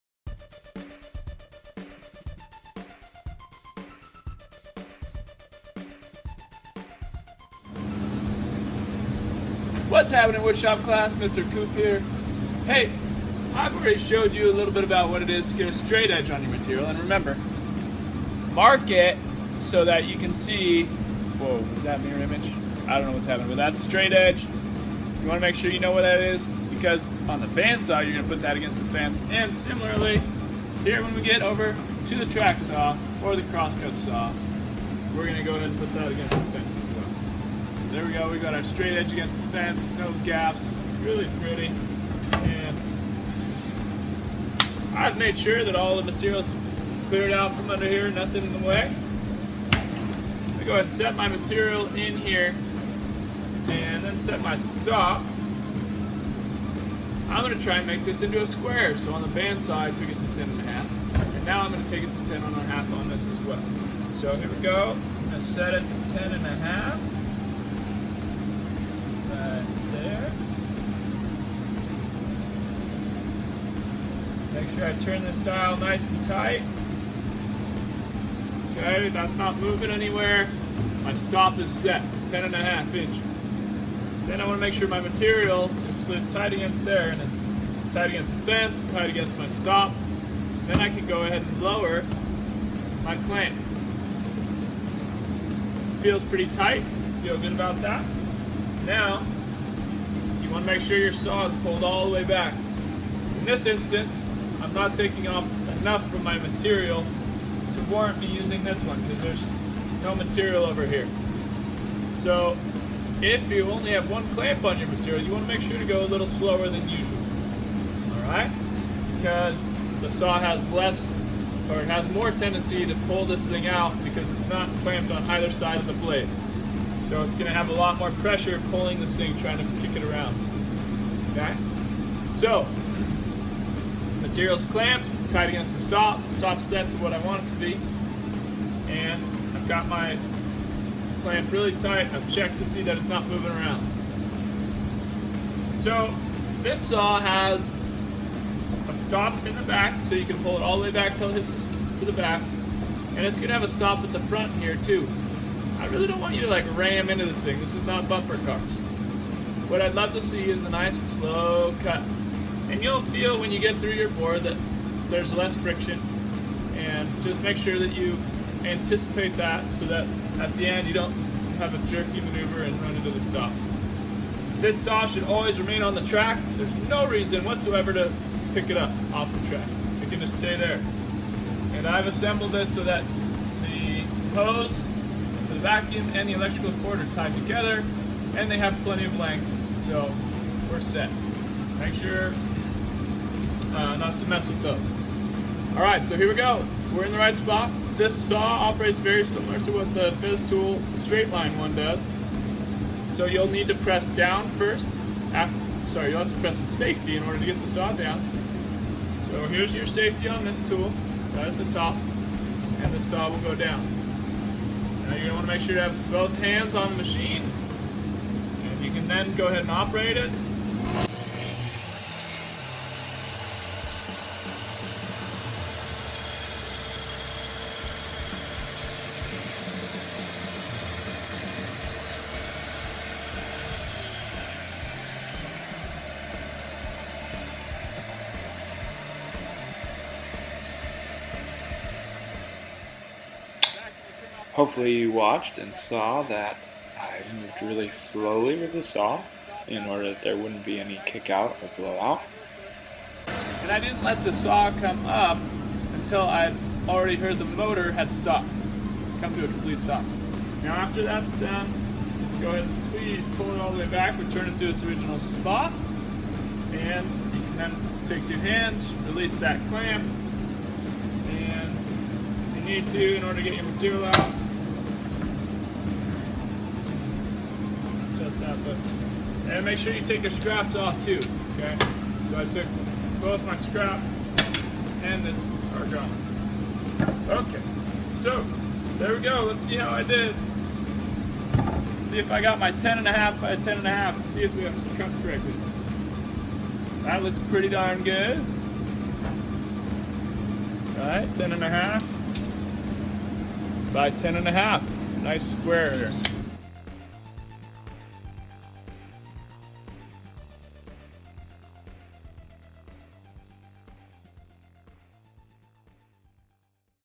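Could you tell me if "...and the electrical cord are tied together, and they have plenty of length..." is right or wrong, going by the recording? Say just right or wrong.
right.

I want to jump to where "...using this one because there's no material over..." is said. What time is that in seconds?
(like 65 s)
108 s.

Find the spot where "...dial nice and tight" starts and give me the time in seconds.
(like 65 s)
75 s.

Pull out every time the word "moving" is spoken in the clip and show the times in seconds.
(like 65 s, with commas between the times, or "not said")
79 s, 143 s.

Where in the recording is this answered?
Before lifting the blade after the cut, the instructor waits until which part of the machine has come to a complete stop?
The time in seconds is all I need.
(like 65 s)
257 s.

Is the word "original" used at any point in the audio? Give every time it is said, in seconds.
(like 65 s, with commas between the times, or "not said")
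264 s.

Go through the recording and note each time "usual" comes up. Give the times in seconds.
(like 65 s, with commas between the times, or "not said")
116 s.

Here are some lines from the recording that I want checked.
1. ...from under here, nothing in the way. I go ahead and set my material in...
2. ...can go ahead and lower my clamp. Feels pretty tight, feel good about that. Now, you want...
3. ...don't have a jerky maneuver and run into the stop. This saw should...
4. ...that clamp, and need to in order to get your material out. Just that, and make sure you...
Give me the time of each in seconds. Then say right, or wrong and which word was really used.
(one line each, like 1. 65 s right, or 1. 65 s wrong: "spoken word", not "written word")
1. 47 s right
2. 90 s right
3. 170 s right
4. 269 s right.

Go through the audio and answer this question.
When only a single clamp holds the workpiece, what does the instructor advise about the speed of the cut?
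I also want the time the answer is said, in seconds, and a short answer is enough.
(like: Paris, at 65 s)
go a little slower, at 115 s.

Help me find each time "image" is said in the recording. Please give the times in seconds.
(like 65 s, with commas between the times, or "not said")
22 s.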